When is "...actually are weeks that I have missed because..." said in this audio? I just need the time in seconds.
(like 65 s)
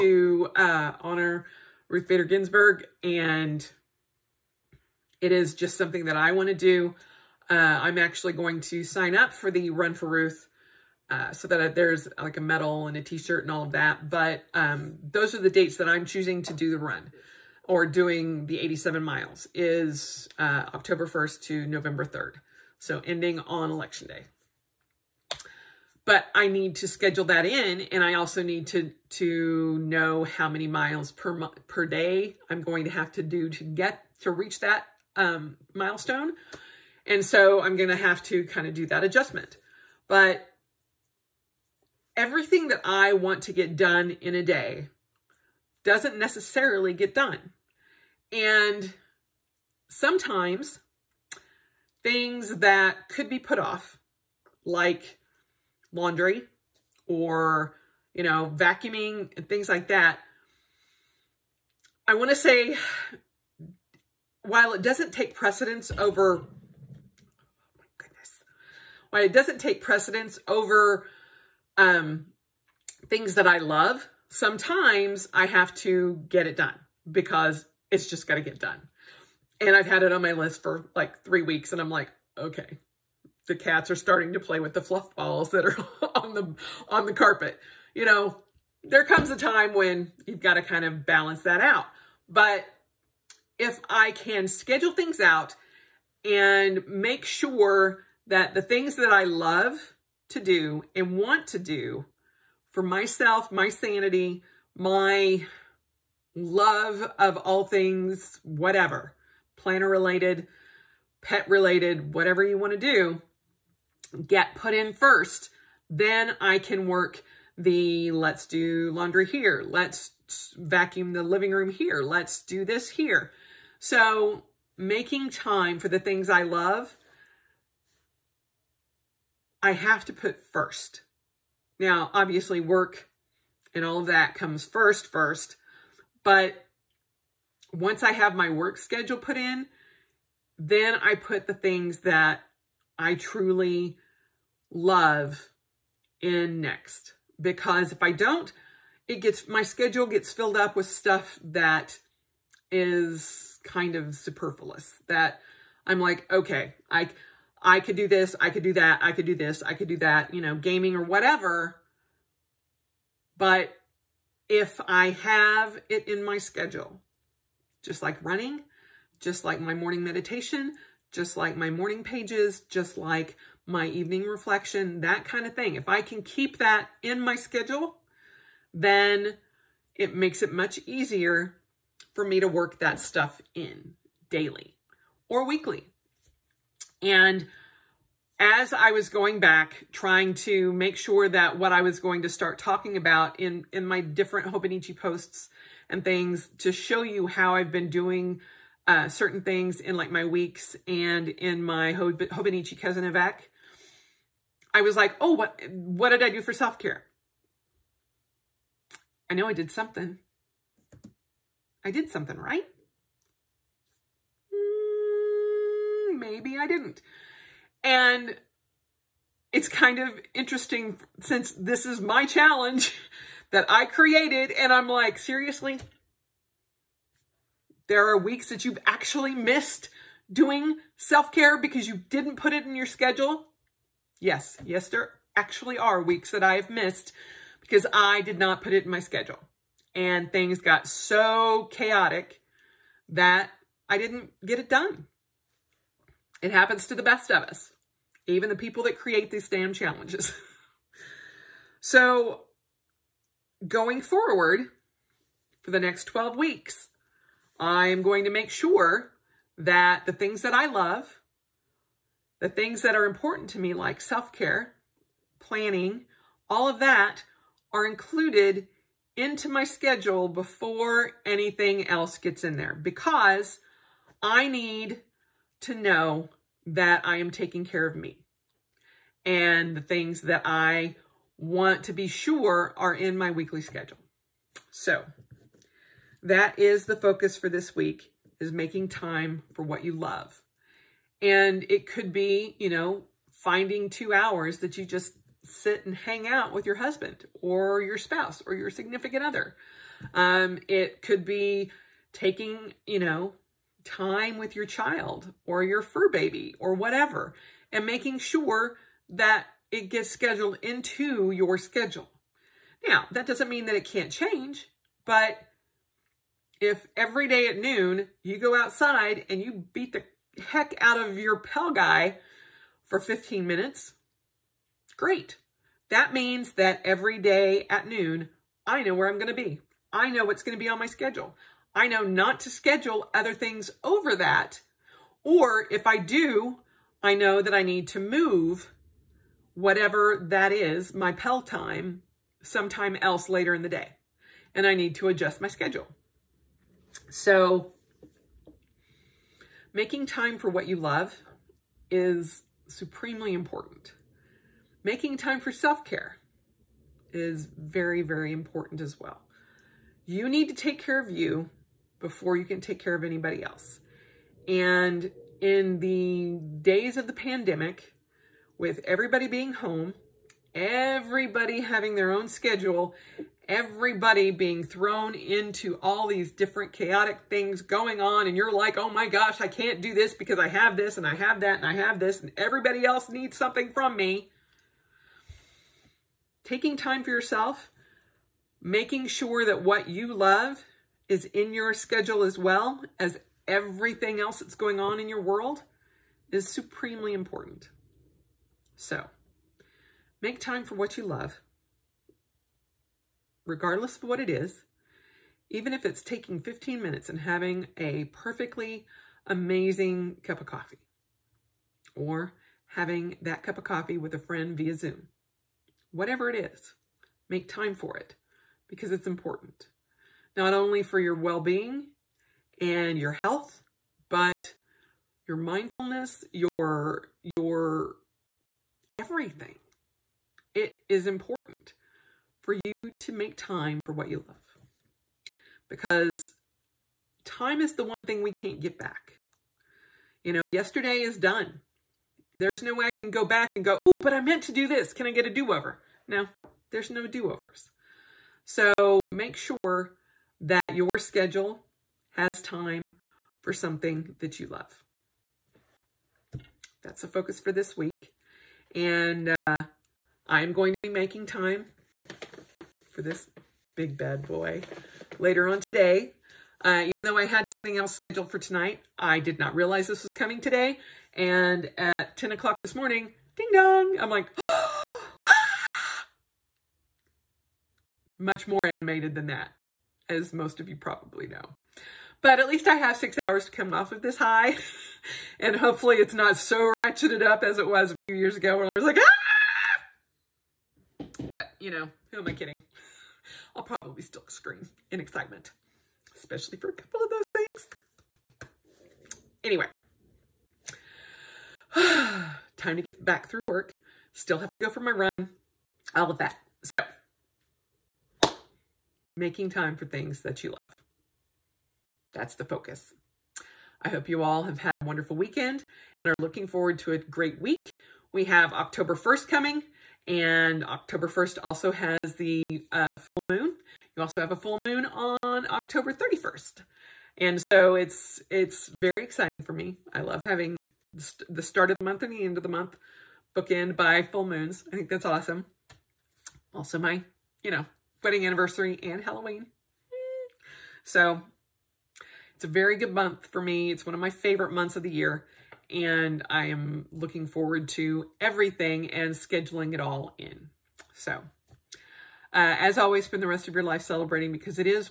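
235 s.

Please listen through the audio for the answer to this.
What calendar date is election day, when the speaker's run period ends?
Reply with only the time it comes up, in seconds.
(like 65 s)
21 s.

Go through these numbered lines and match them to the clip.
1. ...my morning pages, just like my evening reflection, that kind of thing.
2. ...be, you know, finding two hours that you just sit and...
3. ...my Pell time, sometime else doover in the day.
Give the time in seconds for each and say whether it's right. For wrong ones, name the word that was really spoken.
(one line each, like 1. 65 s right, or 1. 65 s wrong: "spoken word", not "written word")
1. 171 s right
2. 292 s right
3. 340 s wrong: "later", not "doover".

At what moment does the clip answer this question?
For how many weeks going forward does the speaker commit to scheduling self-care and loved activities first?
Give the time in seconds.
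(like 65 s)
256 s.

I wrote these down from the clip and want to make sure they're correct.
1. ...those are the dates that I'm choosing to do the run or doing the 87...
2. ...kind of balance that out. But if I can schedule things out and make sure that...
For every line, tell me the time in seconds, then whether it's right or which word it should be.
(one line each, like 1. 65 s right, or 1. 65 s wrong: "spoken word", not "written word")
1. 15 s right
2. 90 s right.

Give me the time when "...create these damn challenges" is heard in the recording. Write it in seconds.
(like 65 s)
248 s.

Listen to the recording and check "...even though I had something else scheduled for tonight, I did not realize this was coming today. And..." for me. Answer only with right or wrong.
right.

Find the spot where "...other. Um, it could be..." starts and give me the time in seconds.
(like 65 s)
299 s.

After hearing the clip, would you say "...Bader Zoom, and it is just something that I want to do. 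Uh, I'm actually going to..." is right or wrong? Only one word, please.
wrong.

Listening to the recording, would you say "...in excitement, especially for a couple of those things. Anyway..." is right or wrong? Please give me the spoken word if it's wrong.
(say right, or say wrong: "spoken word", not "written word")
right.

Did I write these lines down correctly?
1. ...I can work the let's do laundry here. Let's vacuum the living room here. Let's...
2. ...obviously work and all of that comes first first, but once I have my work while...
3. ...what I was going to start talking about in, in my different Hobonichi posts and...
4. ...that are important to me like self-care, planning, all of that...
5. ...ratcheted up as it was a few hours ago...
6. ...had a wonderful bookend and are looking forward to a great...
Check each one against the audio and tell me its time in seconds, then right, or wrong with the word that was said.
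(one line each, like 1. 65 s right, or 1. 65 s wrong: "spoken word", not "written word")
1. 116 s right
2. 132 s wrong: "schedule", not "while"
3. 191 s right
4. 262 s right
5. 486 s wrong: "years", not "hours"
6. 514 s wrong: "weekend", not "bookend".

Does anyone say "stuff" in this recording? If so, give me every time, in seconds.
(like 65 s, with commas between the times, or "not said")
150 s, 182 s.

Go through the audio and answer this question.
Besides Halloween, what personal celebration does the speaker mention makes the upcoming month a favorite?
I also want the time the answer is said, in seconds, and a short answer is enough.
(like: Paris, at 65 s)
wedding anniversary, at 538 s.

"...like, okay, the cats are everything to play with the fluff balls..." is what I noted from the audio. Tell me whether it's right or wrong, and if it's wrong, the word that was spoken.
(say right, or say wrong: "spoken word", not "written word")
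wrong: "starting", not "everything".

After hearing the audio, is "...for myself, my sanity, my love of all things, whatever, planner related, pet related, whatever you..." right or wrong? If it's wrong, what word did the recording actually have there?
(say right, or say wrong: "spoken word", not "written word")
right.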